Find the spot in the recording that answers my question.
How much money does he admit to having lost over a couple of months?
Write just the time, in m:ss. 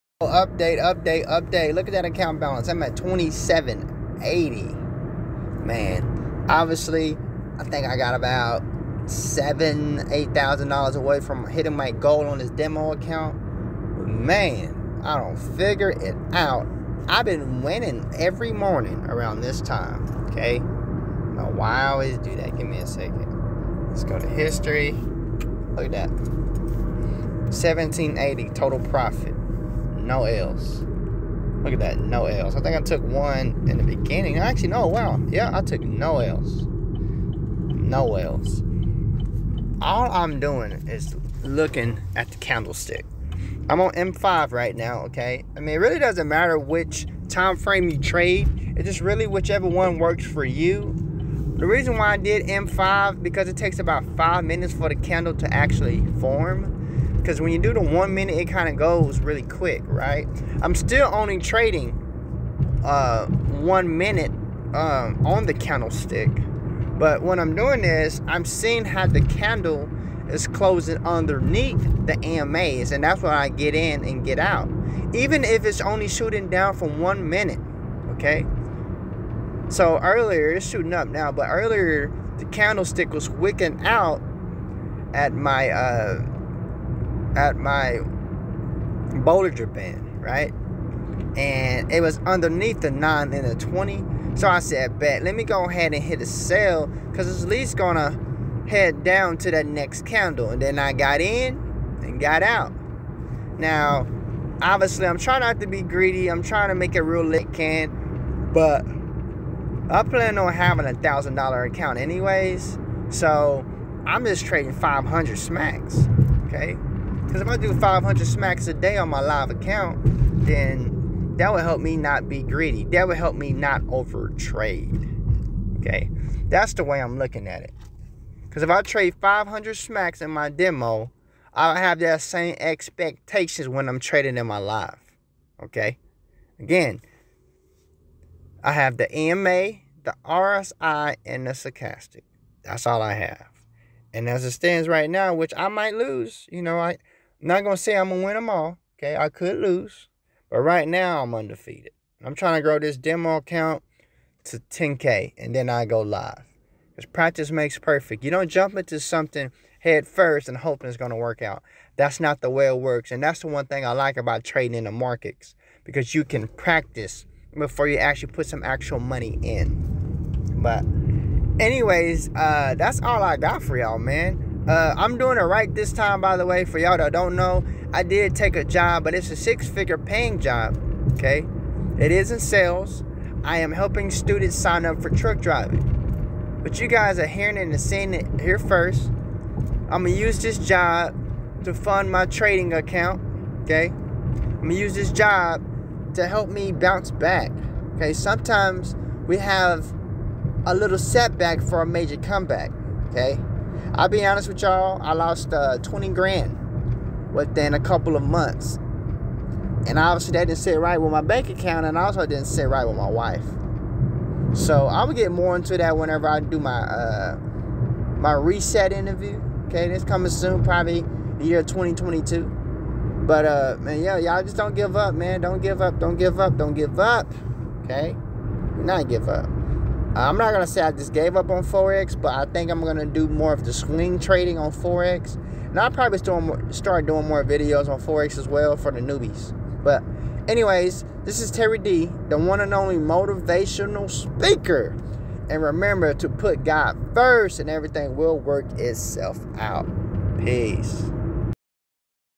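3:25.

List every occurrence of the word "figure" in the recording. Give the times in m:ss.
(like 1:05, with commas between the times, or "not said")
0:15, 2:59.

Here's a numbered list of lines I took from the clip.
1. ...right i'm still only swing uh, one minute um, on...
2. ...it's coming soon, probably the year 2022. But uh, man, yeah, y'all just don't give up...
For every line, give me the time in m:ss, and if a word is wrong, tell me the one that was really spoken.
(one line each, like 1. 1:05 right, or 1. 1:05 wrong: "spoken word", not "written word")
1. 0:59 wrong: "trading", not "swing"
2. 3:39 right.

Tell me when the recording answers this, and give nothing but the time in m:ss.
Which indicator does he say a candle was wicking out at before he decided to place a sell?
1:29.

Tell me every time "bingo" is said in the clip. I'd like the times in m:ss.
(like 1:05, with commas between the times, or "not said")
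not said.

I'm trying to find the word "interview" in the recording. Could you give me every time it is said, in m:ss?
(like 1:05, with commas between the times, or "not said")
3:38.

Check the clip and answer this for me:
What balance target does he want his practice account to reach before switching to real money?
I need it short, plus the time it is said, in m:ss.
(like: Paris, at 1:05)
10K, at 2:34.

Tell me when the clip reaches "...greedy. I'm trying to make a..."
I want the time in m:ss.
1:45.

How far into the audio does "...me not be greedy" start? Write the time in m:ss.
2:01.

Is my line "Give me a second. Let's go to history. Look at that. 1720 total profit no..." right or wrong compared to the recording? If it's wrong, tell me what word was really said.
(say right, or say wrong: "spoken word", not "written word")
wrong: "1780", not "1720".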